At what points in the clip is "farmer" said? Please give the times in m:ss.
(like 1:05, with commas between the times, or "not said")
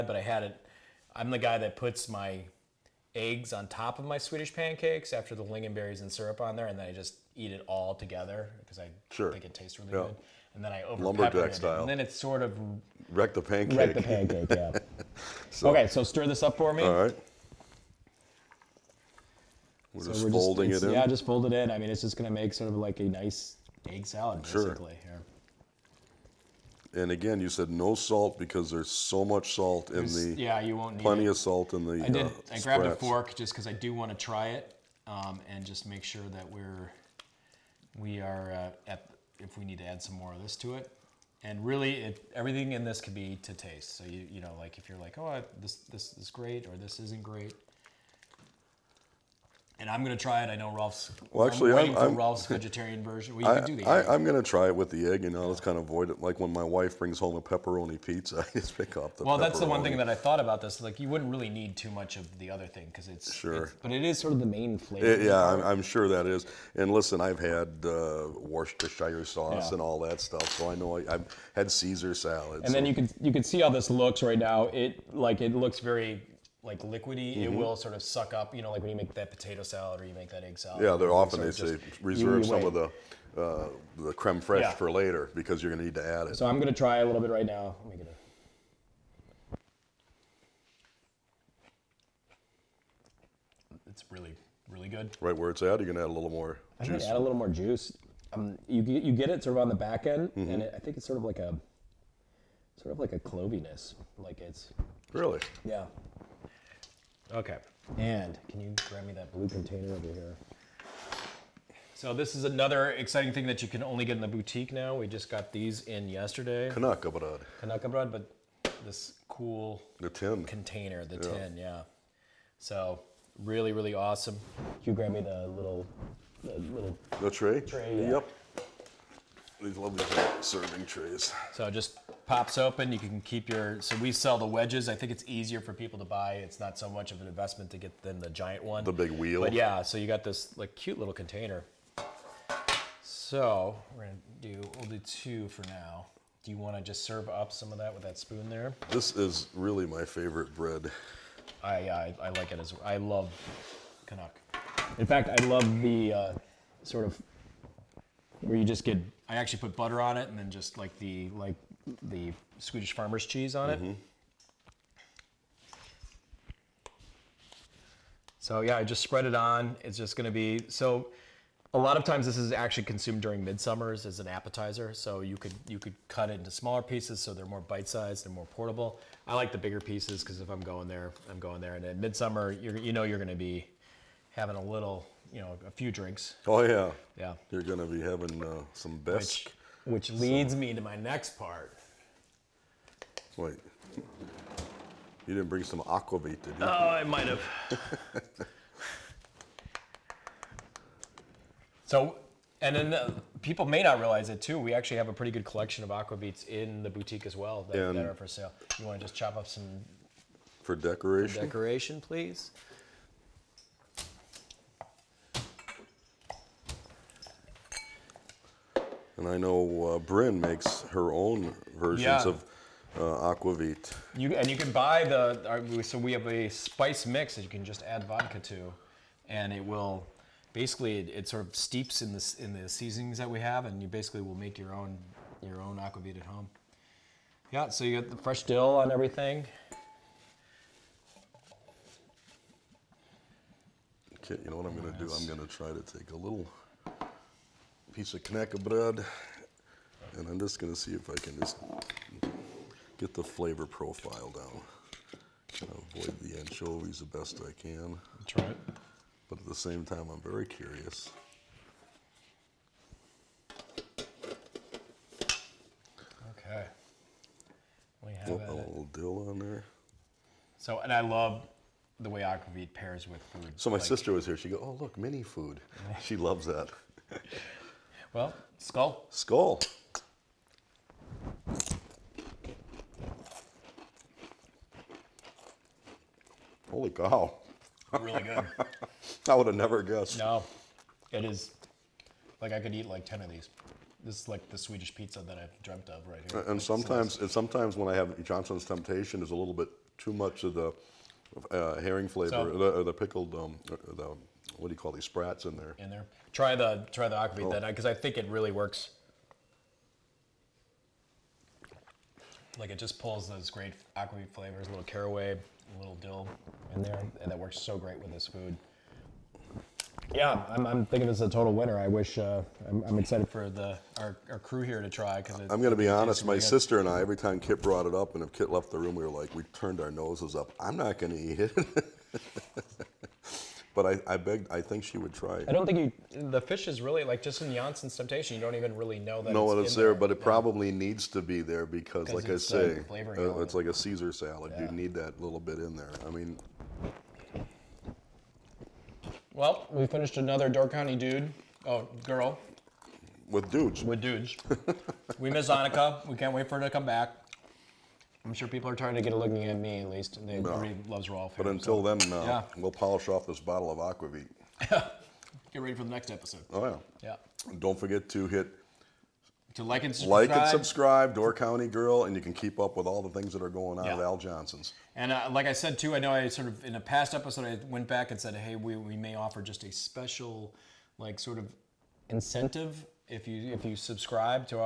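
2:42.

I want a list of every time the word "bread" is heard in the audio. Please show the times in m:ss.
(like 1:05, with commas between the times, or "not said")
2:30, 4:08.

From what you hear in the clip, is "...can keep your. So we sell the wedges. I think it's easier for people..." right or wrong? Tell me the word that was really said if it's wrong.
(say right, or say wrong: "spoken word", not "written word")
right.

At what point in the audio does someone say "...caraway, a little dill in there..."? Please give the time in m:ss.
5:14.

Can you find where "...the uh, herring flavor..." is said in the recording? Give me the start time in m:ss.
5:00.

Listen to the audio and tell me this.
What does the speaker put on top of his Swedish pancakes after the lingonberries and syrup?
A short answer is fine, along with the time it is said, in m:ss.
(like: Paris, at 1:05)
Eggs, at 0:03.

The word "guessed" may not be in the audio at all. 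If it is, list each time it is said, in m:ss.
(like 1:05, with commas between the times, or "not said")
4:49.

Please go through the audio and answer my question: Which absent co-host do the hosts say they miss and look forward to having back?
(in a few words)
Annika.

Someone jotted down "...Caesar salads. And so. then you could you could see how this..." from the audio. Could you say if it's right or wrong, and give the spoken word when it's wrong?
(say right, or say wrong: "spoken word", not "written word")
right.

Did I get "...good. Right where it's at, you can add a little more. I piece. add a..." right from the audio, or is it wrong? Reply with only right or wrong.
wrong.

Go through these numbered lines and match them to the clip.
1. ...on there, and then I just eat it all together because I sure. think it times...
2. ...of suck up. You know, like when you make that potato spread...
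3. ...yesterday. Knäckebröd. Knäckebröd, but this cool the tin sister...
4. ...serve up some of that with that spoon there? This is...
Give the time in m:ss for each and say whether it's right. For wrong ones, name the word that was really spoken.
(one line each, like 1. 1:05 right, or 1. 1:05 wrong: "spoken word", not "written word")
1. 0:06 wrong: "tastes", not "times"
2. 1:17 wrong: "salad", not "spread"
3. 1:56 wrong: "container", not "sister"
4. 2:27 right.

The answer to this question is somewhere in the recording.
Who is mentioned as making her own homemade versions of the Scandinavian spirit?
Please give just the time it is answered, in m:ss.
3:39.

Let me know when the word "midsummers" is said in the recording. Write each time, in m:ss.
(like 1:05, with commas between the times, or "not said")
2:53, 3:01.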